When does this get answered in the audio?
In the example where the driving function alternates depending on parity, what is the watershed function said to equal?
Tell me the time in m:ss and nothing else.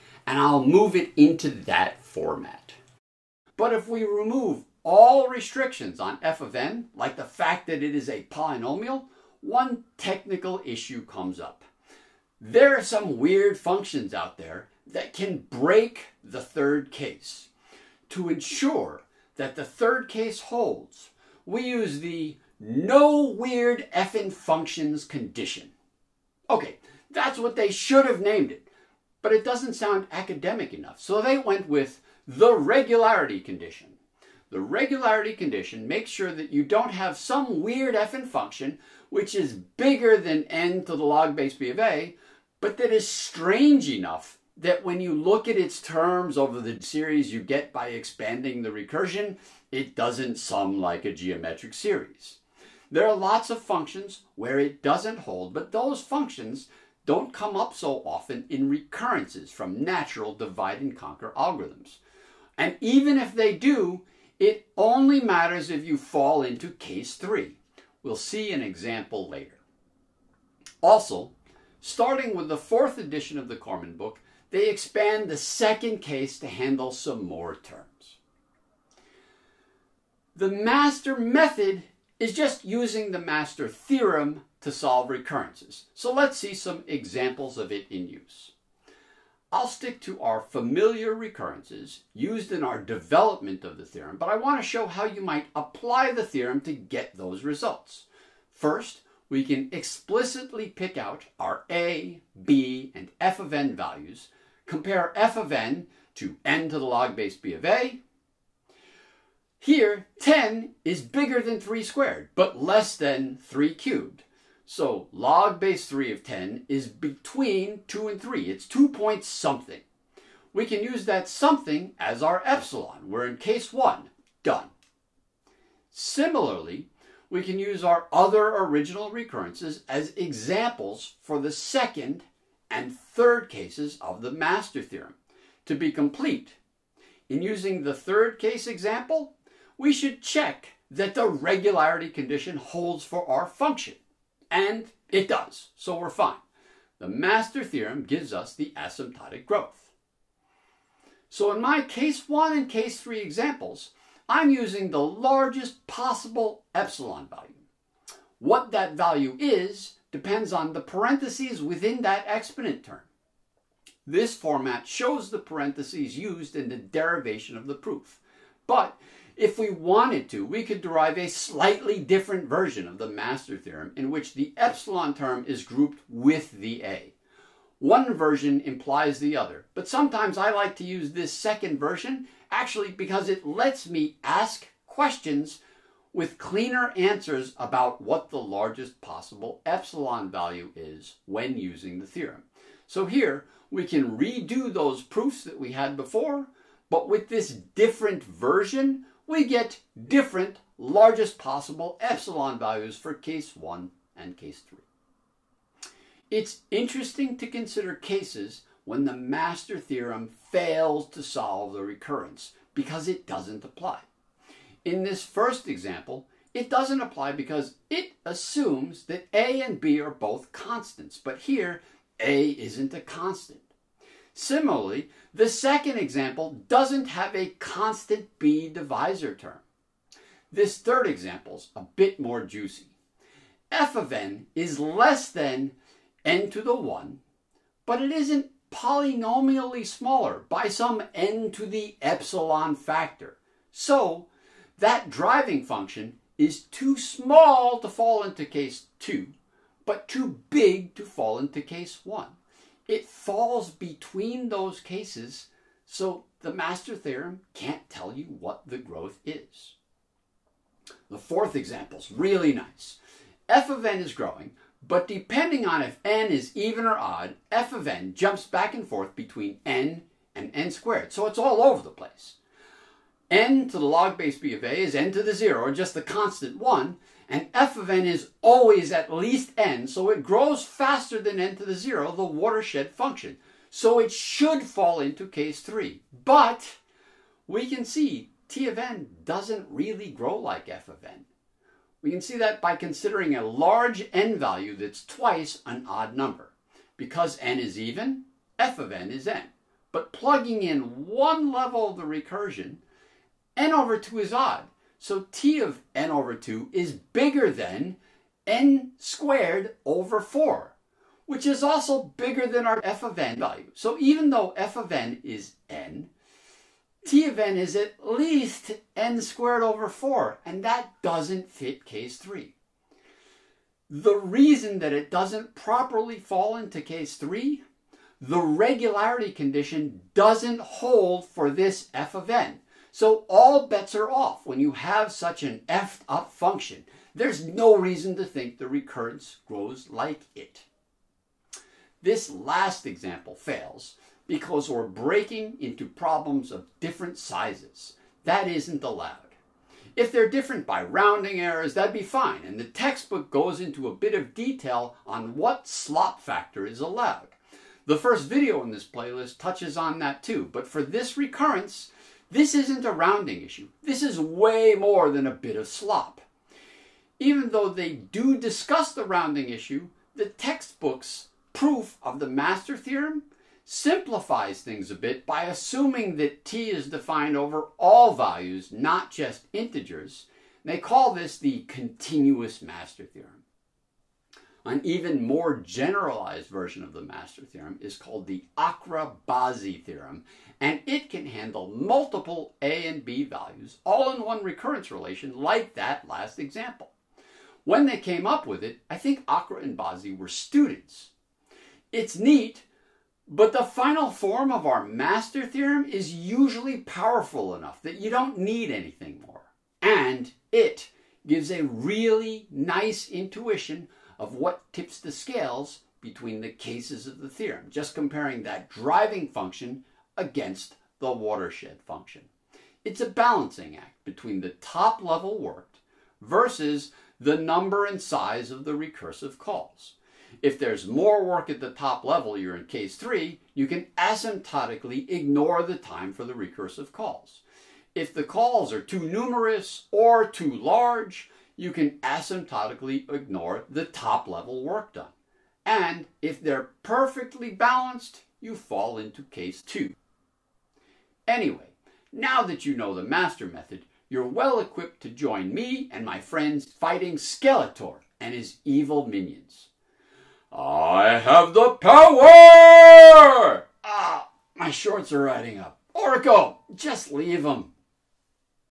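4:35.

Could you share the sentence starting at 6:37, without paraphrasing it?
When they came up with it, I think Akra and Bazzi were students.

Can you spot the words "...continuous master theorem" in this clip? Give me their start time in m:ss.
6:21.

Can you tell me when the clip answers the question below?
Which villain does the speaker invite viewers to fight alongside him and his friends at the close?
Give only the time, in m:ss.
7:37.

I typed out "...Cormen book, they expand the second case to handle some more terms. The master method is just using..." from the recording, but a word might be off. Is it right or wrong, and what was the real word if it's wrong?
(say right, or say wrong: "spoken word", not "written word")
right.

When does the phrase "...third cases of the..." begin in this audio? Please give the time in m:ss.
2:12.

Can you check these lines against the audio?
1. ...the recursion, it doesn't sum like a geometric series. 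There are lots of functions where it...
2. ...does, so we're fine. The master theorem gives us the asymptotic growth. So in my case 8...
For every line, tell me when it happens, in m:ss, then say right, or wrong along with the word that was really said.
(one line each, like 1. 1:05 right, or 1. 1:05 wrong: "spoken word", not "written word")
1. 0:48 right
2. 2:25 wrong: "1", not "8".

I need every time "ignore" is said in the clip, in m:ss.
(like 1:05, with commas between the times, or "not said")
7:15, 7:23.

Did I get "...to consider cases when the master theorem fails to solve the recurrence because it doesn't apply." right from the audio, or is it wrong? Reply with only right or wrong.
right.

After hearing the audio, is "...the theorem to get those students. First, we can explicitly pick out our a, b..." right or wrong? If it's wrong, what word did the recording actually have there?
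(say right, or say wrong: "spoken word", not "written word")
wrong: "results", not "students".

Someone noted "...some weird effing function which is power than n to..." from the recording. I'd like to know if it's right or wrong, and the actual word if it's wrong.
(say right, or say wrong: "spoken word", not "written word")
wrong: "bigger", not "power".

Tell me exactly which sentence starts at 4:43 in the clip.
So it should fall into case three.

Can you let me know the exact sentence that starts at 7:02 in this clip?
It's a balancing act between the top level worked versus the number and size of the recursive calls.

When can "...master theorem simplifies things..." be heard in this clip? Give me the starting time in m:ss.
6:12.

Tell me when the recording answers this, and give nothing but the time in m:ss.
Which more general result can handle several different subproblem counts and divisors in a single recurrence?
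6:28.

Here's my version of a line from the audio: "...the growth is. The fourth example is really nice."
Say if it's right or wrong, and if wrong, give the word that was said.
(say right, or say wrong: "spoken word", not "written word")
right.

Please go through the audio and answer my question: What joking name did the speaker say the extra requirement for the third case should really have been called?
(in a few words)
No weird effing functions condition.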